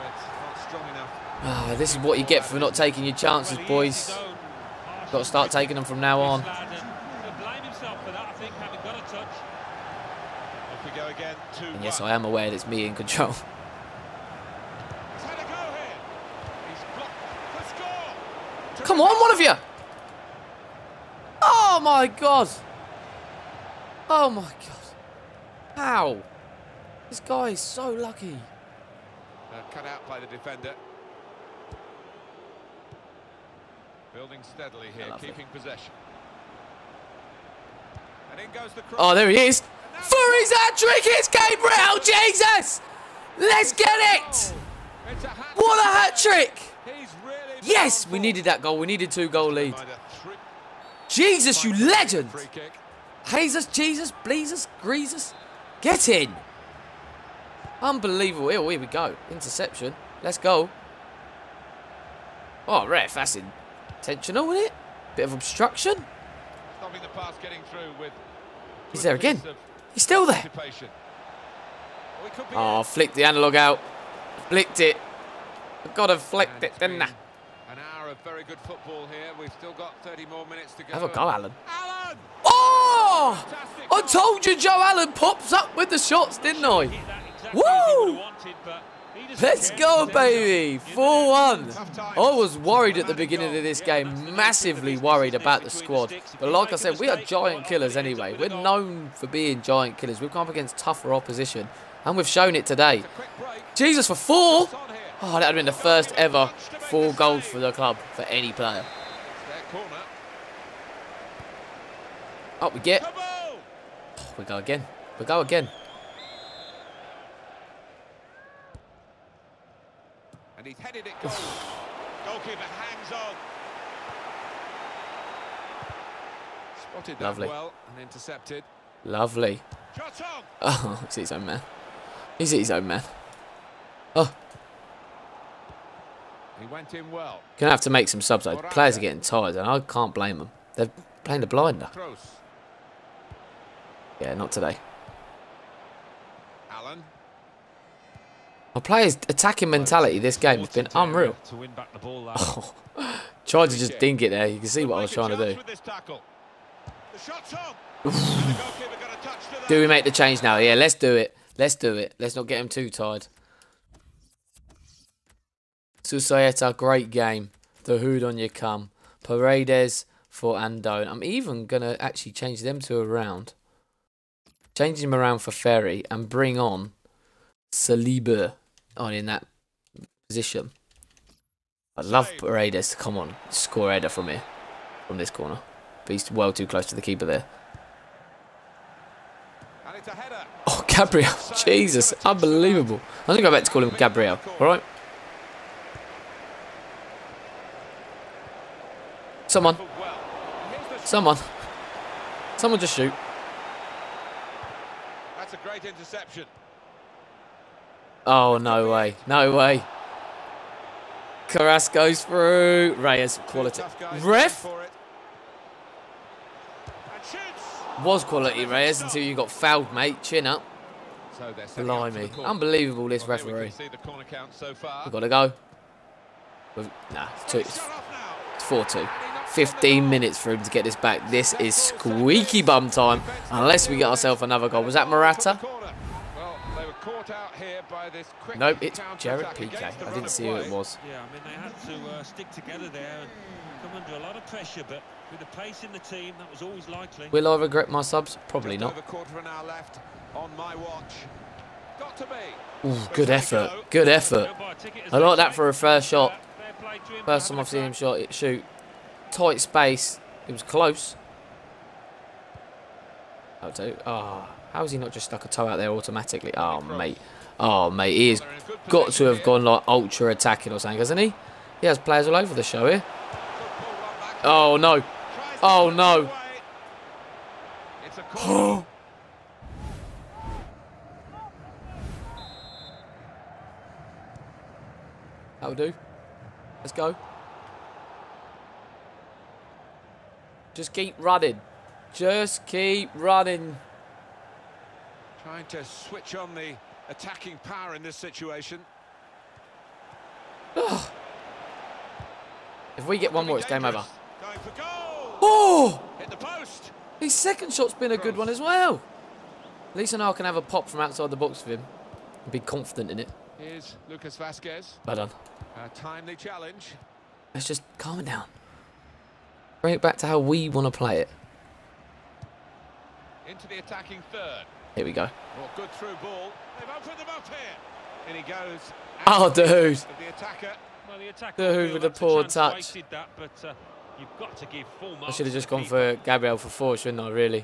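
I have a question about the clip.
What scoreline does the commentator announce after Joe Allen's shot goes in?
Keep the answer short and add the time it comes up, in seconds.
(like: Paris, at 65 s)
4-1, at 90 s.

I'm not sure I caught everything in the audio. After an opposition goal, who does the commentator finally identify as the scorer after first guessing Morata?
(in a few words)
Gerard Piqué.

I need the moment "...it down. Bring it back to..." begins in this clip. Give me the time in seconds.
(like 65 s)
318 s.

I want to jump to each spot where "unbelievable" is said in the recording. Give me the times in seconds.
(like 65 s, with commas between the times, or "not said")
57 s, 192 s, 222 s.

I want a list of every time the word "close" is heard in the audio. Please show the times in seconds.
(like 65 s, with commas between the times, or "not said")
186 s, 260 s.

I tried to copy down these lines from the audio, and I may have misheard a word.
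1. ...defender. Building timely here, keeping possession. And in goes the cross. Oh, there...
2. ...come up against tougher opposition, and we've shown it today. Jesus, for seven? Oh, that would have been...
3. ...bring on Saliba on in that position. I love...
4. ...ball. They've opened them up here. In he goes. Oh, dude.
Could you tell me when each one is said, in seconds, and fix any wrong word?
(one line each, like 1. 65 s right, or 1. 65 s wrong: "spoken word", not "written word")
1. 30 s wrong: "steadily", not "timely"
2. 100 s wrong: "four", not "seven"
3. 176 s right
4. 326 s right.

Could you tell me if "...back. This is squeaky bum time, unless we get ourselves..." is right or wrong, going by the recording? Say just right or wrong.
right.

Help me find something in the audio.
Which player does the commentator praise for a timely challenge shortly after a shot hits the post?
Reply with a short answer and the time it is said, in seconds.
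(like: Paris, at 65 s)
Lucas Vázquez, at 314 s.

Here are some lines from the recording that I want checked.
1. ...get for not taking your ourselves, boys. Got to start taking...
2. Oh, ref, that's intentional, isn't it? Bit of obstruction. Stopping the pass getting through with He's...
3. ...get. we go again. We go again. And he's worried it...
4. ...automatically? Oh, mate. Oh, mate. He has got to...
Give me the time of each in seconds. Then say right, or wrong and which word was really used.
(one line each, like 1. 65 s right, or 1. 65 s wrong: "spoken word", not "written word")
1. 2 s wrong: "chances", not "ourselves"
2. 62 s right
3. 112 s wrong: "headed", not "worried"
4. 265 s right.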